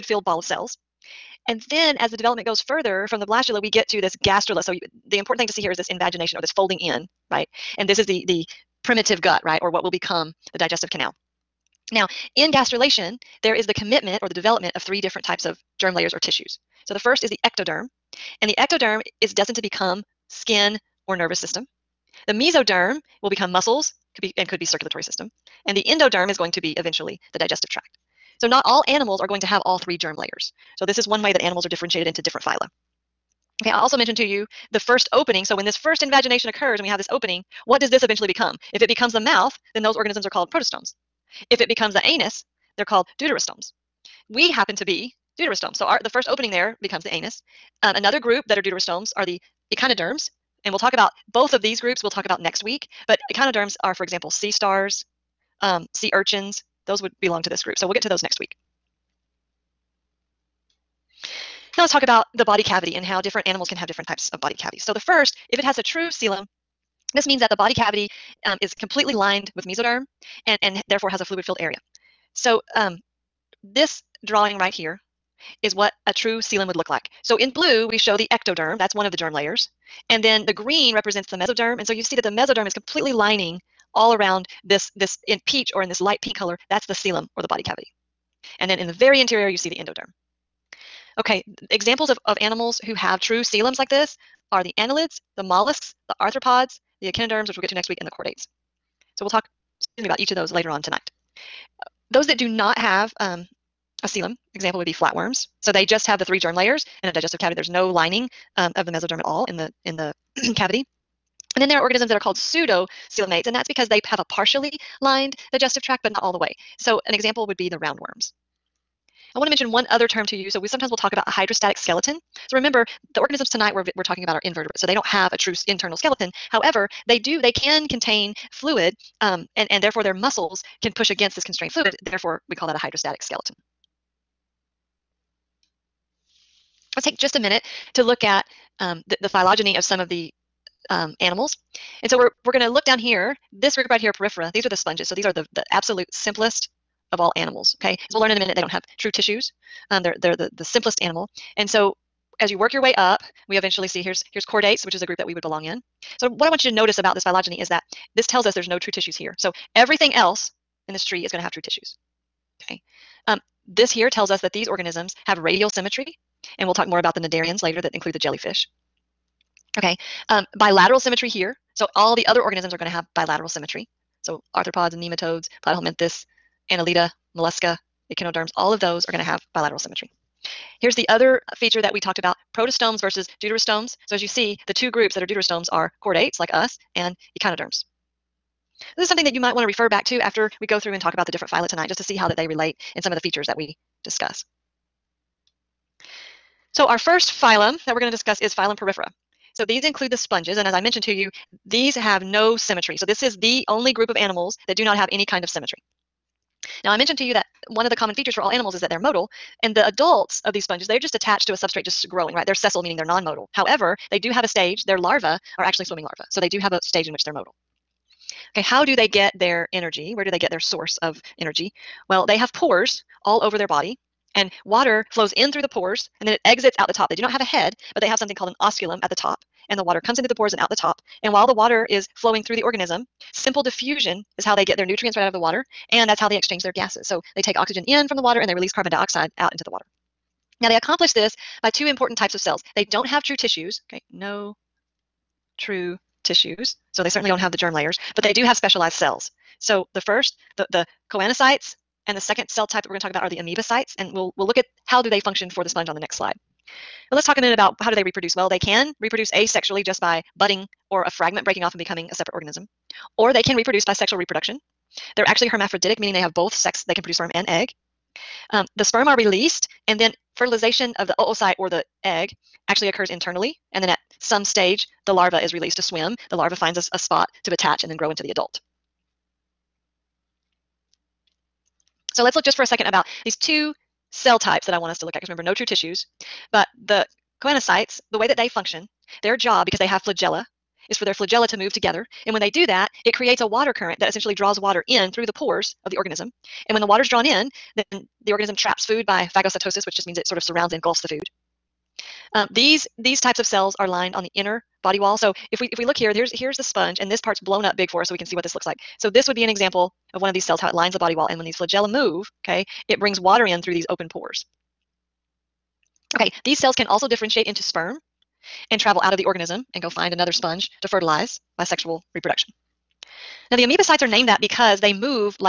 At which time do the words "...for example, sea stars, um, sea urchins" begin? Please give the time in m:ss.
0:53.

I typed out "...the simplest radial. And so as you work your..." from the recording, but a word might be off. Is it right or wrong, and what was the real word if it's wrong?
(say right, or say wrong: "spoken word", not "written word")
wrong: "animal", not "radial".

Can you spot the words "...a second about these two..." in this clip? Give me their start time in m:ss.
4:42.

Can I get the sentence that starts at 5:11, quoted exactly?
And when these flagella move, okay, it brings water in through these open pores.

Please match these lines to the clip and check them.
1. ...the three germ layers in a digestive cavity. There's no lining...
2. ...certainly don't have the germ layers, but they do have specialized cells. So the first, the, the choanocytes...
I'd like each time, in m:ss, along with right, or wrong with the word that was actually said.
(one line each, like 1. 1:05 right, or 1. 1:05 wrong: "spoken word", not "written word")
1. 1:46 right
2. 4:07 right.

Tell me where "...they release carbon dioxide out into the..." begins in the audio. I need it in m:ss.
3:58.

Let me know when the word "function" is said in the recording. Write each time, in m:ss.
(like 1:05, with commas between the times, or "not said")
4:15, 4:48.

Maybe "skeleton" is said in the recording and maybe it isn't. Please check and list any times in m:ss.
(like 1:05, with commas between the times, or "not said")
2:01, 2:05, 2:13.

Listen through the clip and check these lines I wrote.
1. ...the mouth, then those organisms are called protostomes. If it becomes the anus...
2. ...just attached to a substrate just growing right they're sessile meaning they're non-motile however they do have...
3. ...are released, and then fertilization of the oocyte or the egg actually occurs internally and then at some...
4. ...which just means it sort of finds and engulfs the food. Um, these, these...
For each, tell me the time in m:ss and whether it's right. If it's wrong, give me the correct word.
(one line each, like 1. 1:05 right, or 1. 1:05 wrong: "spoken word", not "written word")
1. 0:39 right
2. 3:30 right
3. 4:29 right
4. 4:59 wrong: "surrounds", not "finds".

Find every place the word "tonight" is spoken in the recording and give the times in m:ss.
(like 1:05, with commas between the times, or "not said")
1:40, 2:03, 3:11.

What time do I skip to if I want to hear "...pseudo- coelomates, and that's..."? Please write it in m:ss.
1:52.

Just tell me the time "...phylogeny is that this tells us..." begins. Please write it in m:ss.
2:37.